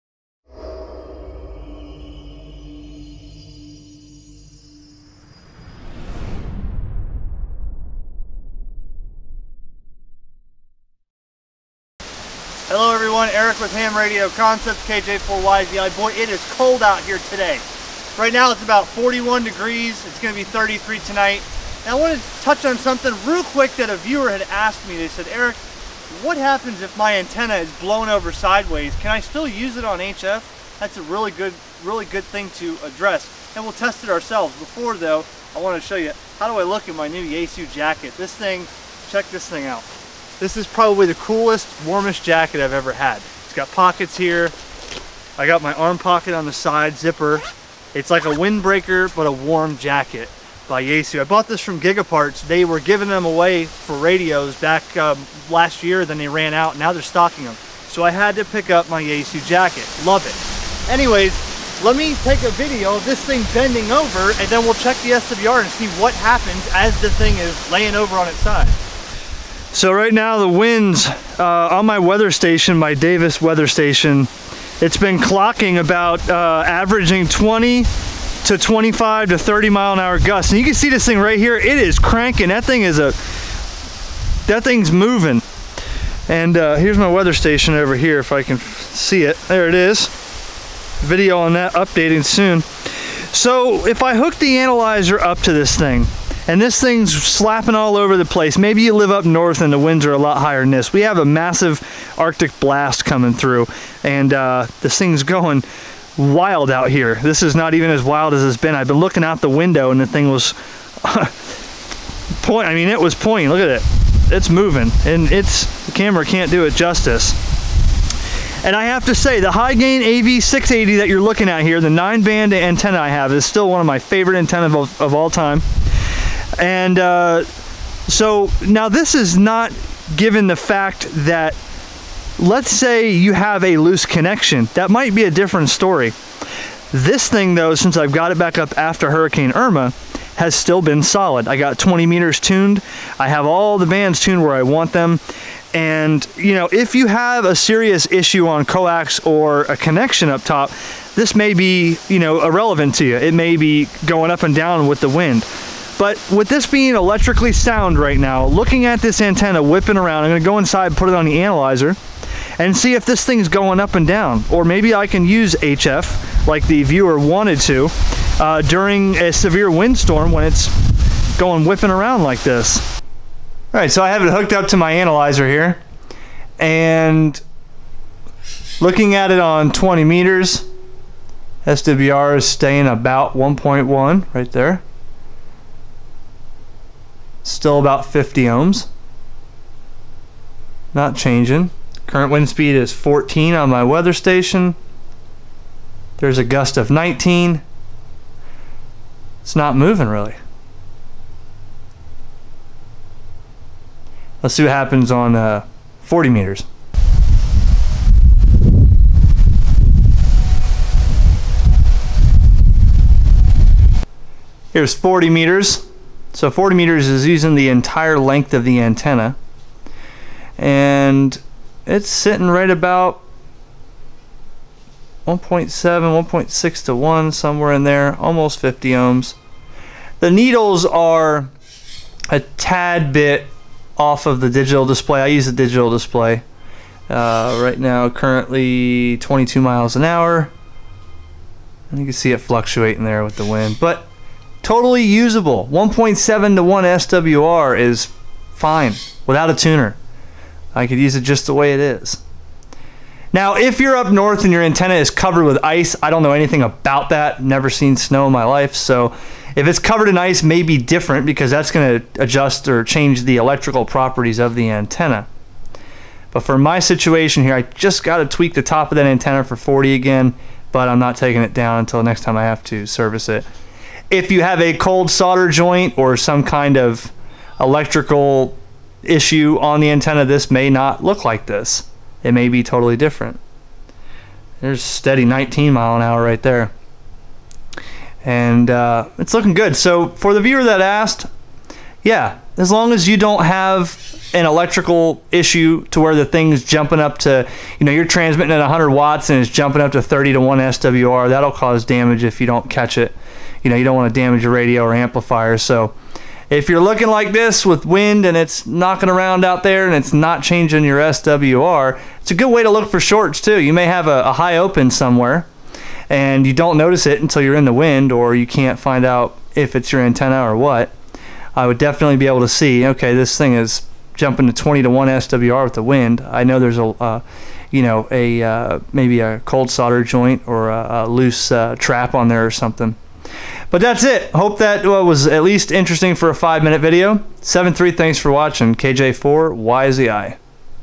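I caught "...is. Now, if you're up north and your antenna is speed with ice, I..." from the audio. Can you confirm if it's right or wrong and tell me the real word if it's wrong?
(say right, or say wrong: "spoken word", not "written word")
wrong: "covered", not "speed".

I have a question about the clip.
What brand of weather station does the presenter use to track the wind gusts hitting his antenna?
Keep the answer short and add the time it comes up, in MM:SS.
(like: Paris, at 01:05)
Davis, at 01:12.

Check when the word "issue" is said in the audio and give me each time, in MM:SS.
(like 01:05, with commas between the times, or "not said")
02:28, 04:39, 04:55.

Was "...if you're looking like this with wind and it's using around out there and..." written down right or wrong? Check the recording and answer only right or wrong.
wrong.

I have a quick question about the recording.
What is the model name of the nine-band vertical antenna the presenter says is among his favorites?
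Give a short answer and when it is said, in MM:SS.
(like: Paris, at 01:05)
Hy-Gain AV680, at 01:59.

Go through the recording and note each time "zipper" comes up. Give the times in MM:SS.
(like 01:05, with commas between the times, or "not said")
00:46.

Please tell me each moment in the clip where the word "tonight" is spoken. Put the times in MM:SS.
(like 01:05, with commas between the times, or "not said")
00:20.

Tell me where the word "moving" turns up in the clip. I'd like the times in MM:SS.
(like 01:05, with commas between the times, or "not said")
01:24, 01:54, 03:19.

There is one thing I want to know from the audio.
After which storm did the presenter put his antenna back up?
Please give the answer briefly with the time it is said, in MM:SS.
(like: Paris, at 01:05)
Hurricane Irma, at 02:19.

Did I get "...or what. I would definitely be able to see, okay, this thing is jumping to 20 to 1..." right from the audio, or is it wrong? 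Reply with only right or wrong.
right.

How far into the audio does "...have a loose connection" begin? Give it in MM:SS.
02:13.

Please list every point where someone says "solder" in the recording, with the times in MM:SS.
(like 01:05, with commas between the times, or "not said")
04:35, 05:29.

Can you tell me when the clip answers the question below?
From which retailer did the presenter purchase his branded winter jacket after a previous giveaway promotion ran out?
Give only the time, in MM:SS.
00:51.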